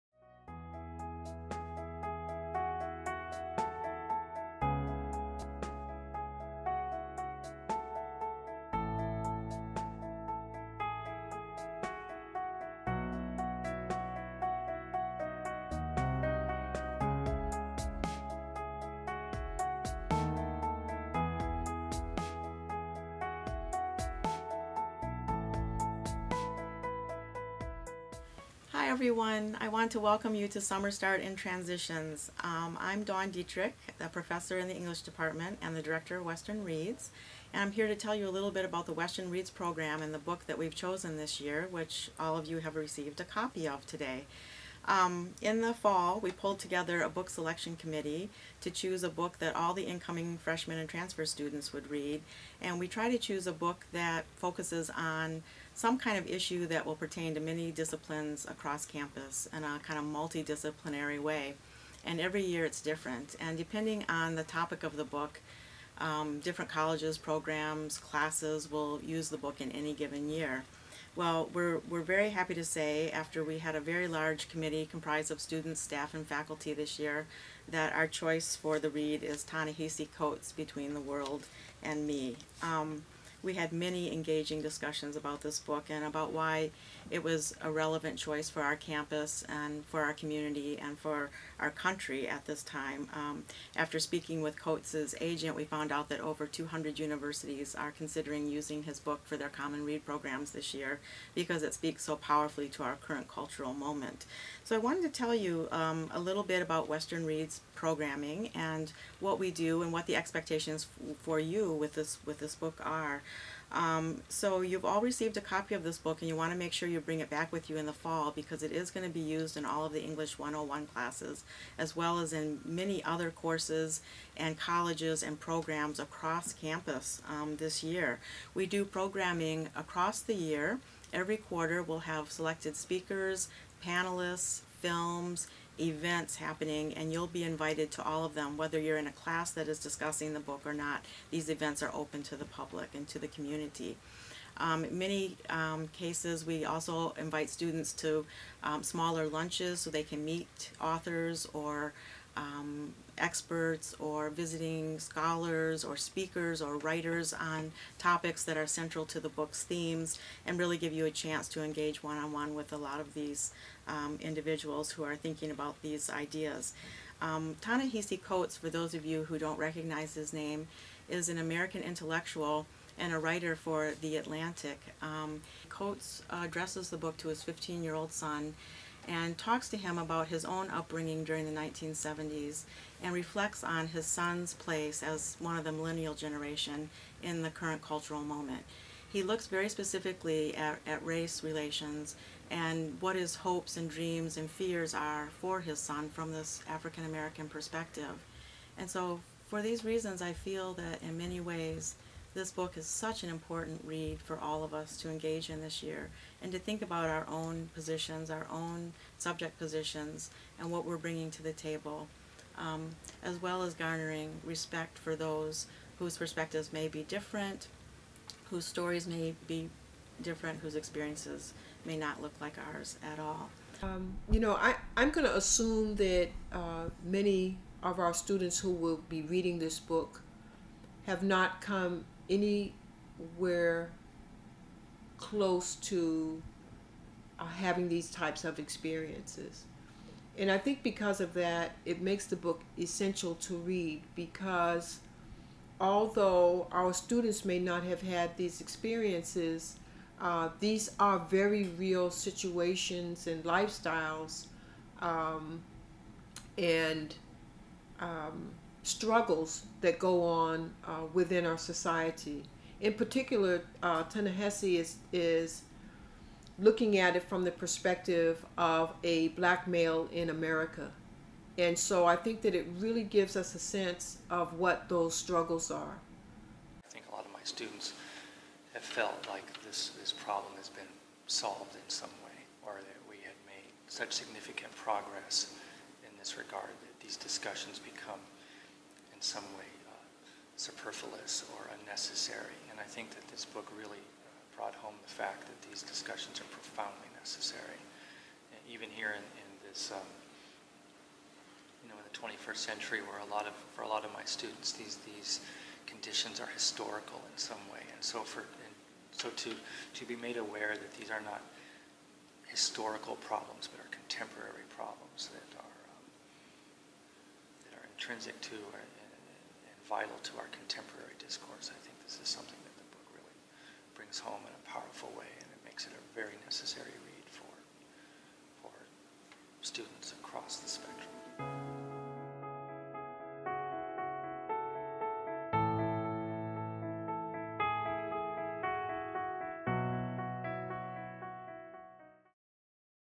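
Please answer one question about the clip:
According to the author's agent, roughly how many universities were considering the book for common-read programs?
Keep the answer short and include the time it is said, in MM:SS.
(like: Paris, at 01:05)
200, at 01:36.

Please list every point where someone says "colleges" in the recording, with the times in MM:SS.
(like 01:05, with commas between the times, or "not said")
01:06, 02:04.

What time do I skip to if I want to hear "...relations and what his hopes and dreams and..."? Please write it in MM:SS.
03:11.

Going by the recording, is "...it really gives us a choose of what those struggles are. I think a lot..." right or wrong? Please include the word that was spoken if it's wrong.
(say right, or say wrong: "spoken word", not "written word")
wrong: "sense", not "choose".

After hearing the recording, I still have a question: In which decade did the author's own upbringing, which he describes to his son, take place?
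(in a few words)
1970s.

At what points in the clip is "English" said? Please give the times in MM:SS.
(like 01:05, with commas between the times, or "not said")
00:34, 02:00.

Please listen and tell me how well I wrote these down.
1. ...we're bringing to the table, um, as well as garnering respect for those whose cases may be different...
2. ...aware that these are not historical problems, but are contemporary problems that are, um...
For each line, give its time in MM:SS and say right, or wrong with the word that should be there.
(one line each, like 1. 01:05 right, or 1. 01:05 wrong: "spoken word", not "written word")
1. 03:30 wrong: "perspectives", not "cases"
2. 05:10 right.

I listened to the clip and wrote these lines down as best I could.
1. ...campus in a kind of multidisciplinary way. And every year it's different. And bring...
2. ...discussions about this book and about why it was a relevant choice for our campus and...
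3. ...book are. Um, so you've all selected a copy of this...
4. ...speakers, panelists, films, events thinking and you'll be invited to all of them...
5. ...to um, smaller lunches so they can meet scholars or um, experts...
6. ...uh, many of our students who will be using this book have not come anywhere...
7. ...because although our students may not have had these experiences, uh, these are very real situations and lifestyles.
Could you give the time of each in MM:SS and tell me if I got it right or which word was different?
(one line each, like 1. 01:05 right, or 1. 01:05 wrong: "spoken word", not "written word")
1. 00:58 wrong: "depending", not "bring"
2. 01:24 right
3. 01:52 wrong: "received", not "selected"
4. 02:12 wrong: "happening", not "thinking"
5. 02:27 wrong: "authors", not "scholars"
6. 03:46 wrong: "reading", not "using"
7. 04:04 right.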